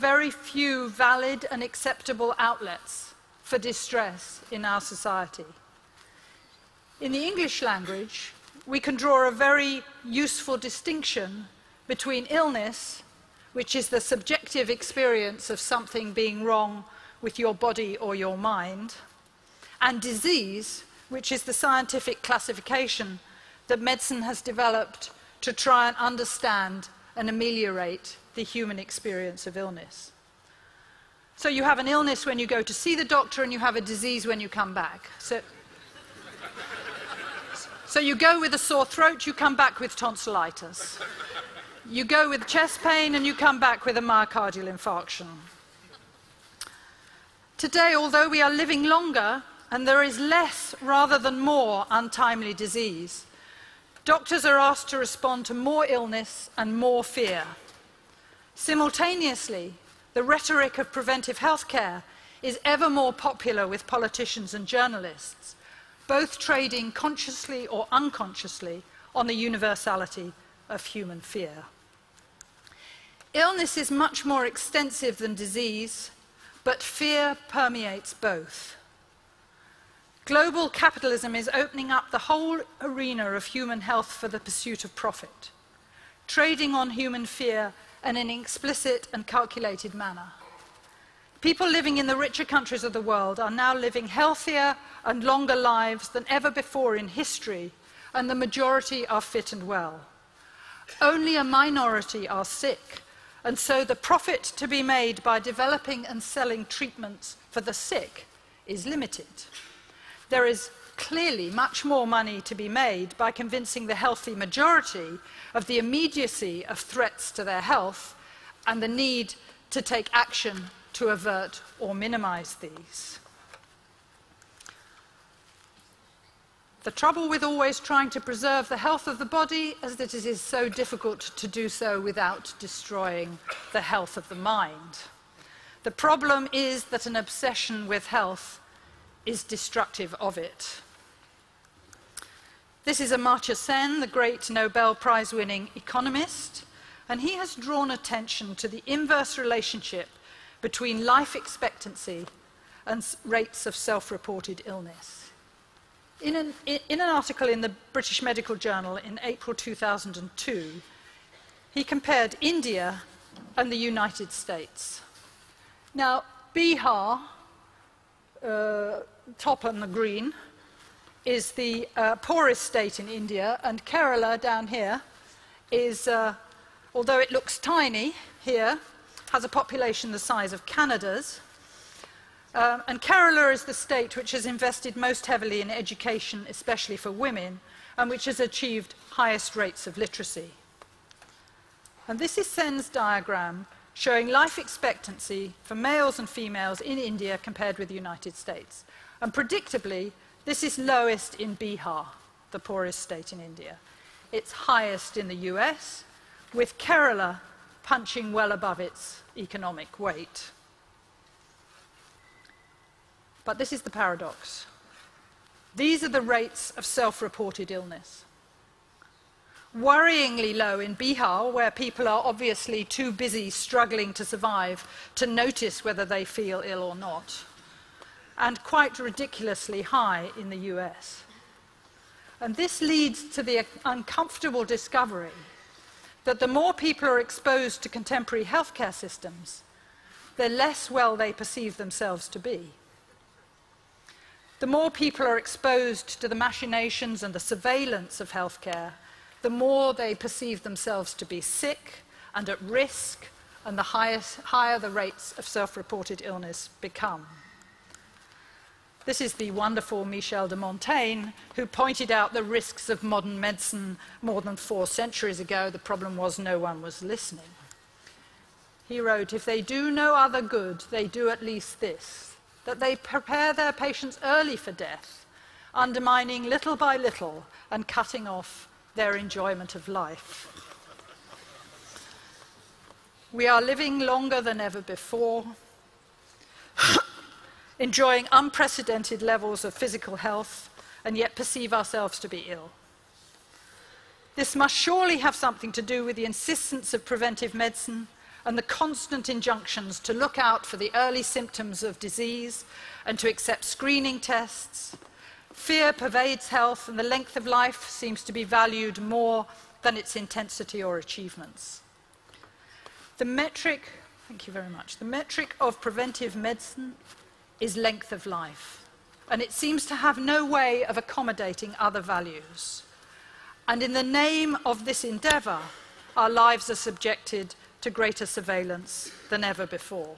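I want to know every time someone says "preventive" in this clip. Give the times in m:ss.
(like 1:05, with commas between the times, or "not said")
1:00, 4:57, 5:15.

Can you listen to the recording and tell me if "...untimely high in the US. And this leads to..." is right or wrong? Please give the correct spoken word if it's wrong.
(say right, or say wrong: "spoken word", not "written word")
wrong: "ridiculously", not "untimely".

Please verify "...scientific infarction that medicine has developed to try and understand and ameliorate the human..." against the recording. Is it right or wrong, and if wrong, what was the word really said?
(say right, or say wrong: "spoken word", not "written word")
wrong: "classification", not "infarction".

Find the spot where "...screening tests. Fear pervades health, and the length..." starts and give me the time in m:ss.
5:03.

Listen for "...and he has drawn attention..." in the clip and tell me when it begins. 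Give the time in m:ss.
2:27.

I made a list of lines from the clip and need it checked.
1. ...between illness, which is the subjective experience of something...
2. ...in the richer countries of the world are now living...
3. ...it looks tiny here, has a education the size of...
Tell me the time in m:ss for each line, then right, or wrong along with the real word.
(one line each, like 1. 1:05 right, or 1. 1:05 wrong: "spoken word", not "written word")
1. 0:11 right
2. 1:31 right
3. 2:57 wrong: "population", not "education".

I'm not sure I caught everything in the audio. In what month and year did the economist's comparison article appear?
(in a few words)
April 2002.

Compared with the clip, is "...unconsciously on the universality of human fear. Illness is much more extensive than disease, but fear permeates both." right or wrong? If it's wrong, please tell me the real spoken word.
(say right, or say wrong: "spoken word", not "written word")
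right.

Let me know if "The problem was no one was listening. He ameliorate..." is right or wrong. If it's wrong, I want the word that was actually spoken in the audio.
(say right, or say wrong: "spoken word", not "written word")
wrong: "wrote", not "ameliorate".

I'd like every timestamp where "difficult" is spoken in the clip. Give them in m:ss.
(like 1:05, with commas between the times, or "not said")
2:10.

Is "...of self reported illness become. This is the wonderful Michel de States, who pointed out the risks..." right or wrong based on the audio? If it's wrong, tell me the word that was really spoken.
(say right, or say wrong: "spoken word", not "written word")
wrong: "Montaigne", not "States".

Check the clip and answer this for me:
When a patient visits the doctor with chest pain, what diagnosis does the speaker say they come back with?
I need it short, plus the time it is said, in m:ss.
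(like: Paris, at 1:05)
myocardial infarction, at 0:44.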